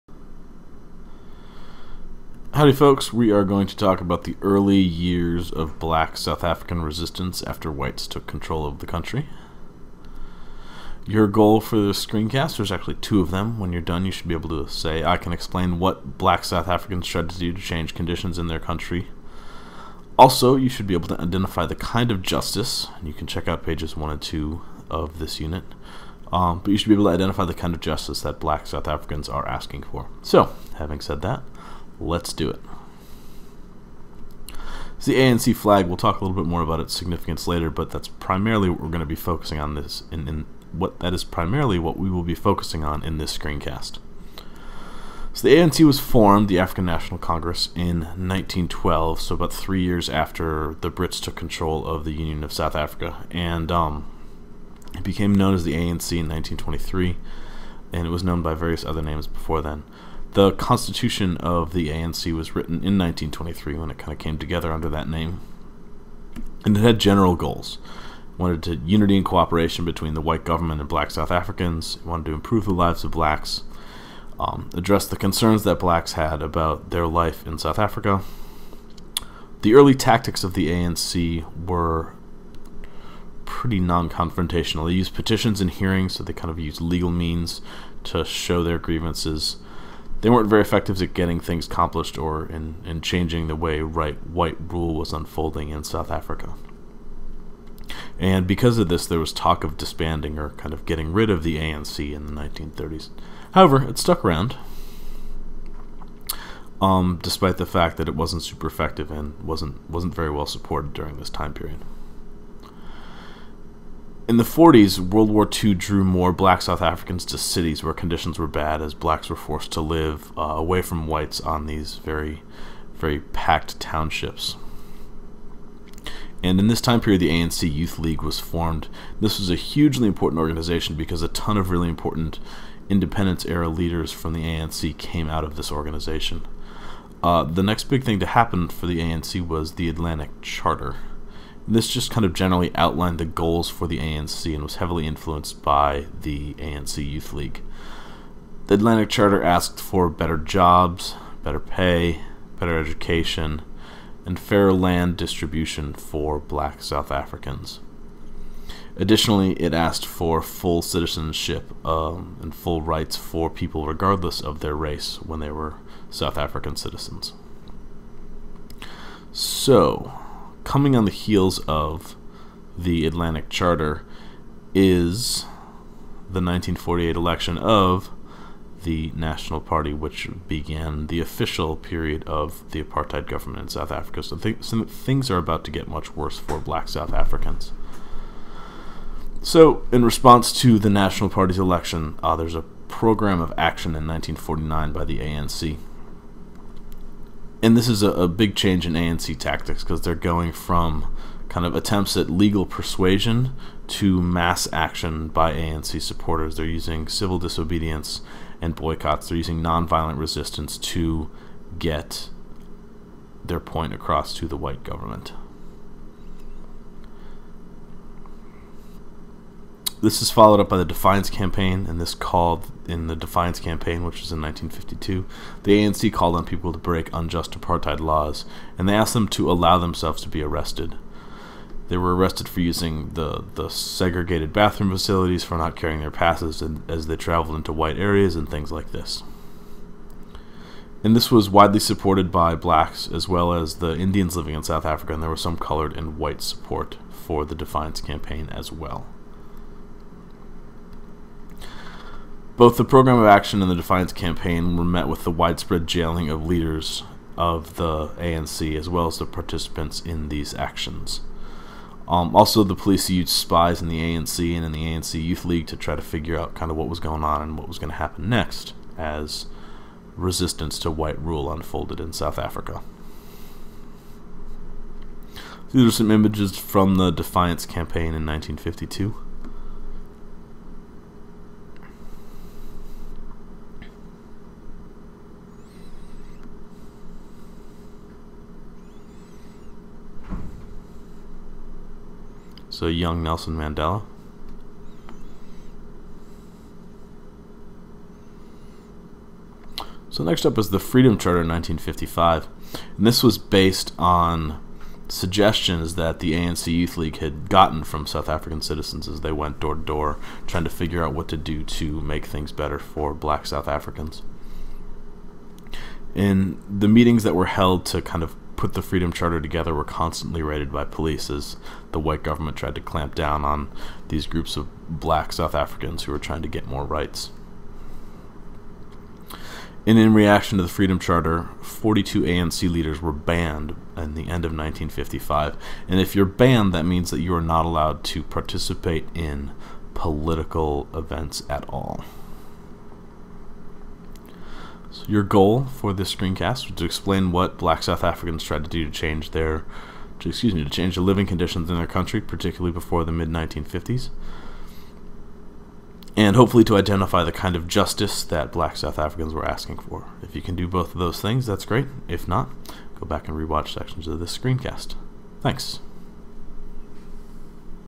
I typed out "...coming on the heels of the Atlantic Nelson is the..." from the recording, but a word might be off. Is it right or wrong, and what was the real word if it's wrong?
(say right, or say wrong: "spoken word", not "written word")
wrong: "Charter", not "Nelson".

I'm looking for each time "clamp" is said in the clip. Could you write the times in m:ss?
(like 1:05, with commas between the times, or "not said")
5:22.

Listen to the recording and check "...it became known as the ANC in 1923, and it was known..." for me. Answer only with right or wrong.
right.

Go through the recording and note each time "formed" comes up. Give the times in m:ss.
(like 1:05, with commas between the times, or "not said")
0:45, 2:08.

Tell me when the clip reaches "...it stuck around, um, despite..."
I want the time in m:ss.
1:43.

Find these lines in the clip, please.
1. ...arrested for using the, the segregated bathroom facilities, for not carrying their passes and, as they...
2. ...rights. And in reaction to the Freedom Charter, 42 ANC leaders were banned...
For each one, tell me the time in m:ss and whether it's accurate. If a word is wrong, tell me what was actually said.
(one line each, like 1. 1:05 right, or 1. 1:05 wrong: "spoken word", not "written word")
1. 3:52 right
2. 5:26 right.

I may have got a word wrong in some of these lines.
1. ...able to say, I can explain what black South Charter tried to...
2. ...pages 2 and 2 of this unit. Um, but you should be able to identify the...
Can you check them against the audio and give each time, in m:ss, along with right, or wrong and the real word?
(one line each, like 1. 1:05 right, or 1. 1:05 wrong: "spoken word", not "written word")
1. 0:14 wrong: "Africans", not "Charter"
2. 0:23 wrong: "1", not "2".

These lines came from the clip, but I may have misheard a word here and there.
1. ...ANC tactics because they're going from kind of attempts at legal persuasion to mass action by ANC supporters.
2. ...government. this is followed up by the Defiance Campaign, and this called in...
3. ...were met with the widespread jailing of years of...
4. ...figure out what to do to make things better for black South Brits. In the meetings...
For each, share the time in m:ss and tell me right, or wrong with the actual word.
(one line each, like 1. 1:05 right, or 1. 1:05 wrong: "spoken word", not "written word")
1. 3:18 right
2. 3:34 right
3. 4:14 wrong: "leaders", not "years"
4. 5:10 wrong: "Africans", not "Brits".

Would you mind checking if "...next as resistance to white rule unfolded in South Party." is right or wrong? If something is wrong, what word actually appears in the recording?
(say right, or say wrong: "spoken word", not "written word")
wrong: "Africa", not "Party".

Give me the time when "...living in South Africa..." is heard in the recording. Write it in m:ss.
4:04.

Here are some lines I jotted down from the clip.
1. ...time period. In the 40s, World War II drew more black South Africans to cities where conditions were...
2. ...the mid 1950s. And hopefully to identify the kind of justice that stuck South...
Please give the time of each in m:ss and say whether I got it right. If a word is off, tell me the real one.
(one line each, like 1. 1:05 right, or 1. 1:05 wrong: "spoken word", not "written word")
1. 1:51 right
2. 5:53 wrong: "black", not "stuck".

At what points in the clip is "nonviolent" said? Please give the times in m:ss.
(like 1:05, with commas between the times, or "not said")
3:29.